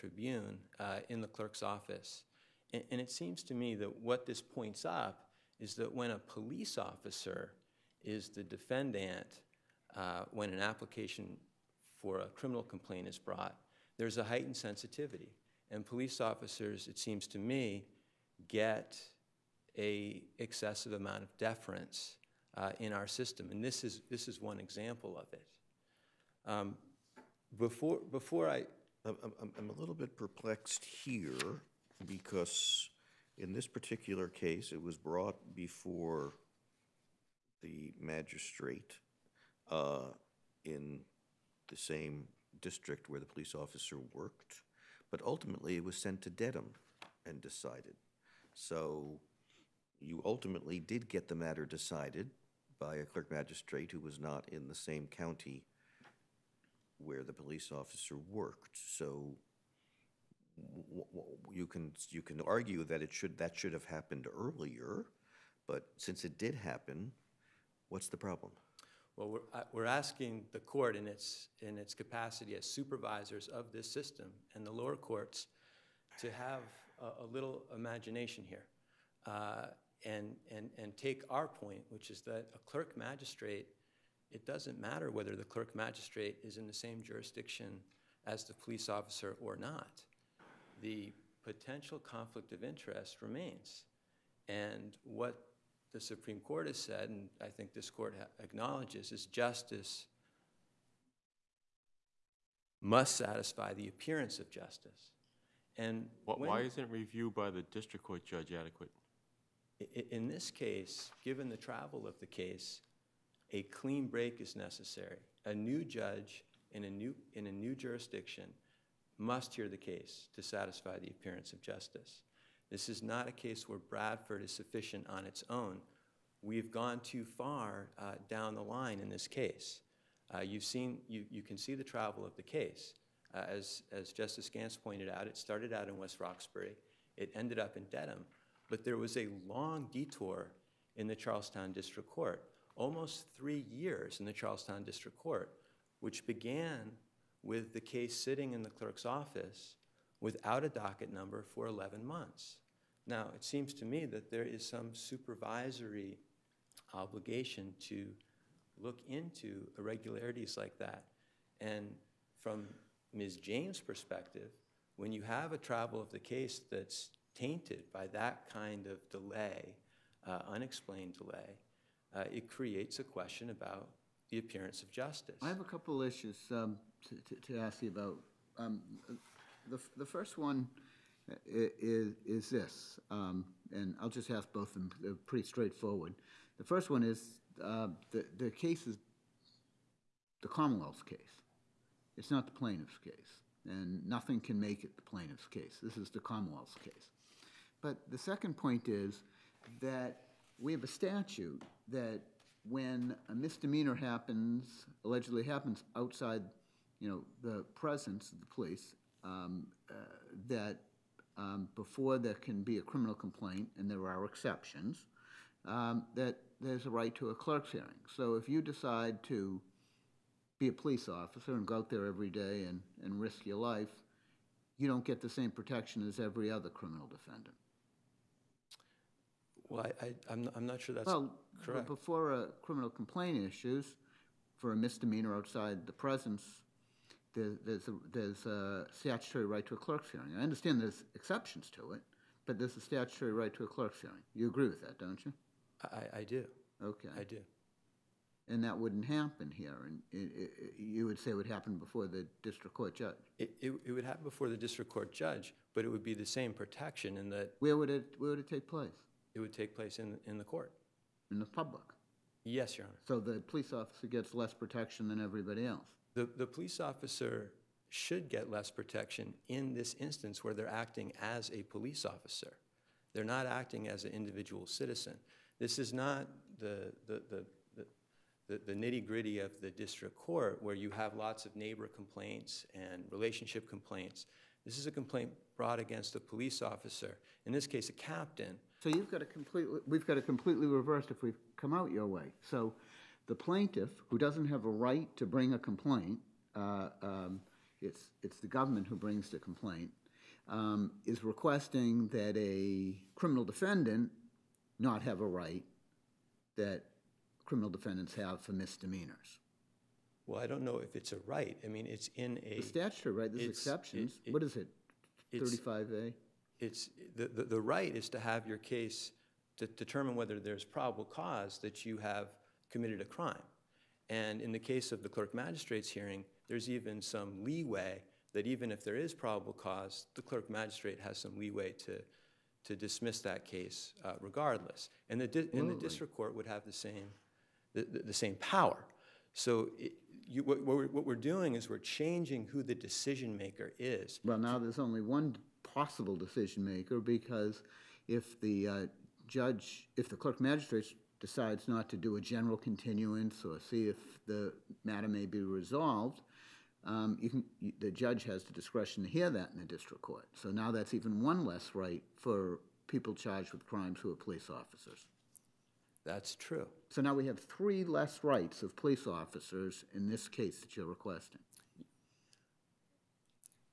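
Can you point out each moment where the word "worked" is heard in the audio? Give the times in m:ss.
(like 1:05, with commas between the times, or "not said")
0:44, 0:58.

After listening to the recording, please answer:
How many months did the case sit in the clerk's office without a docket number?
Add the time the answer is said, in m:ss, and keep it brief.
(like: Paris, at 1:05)
11, at 2:31.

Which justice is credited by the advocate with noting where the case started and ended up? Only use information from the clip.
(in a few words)
Justice Gants.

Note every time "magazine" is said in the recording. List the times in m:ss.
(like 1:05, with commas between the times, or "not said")
not said.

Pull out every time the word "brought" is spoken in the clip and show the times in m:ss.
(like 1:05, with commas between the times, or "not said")
0:13, 0:34, 4:45.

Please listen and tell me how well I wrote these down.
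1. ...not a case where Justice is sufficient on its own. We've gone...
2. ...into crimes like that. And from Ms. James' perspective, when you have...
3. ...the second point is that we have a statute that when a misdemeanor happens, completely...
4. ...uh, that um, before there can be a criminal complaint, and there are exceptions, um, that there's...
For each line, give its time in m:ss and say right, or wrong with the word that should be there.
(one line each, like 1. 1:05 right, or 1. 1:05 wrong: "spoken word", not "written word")
1. 2:03 wrong: "Bradford", not "Justice"
2. 2:39 wrong: "irregularities", not "crimes"
3. 3:18 wrong: "allegedly", not "completely"
4. 3:29 right.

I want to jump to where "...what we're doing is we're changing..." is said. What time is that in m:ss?
5:40.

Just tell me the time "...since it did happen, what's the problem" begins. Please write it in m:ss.
1:05.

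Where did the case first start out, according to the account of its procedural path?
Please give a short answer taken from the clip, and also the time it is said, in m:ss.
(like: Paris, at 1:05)
West Roxbury, at 2:15.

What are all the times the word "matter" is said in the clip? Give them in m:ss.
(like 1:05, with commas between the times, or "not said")
0:51, 1:24, 5:54.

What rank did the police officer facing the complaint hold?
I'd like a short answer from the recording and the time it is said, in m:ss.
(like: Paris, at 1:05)
captain, at 4:47.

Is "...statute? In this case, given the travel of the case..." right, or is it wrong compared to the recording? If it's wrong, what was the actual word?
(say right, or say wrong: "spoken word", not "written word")
wrong: "adequate", not "statute".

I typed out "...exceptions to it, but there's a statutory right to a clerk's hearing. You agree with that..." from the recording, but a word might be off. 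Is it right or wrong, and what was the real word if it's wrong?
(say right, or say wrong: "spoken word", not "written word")
right.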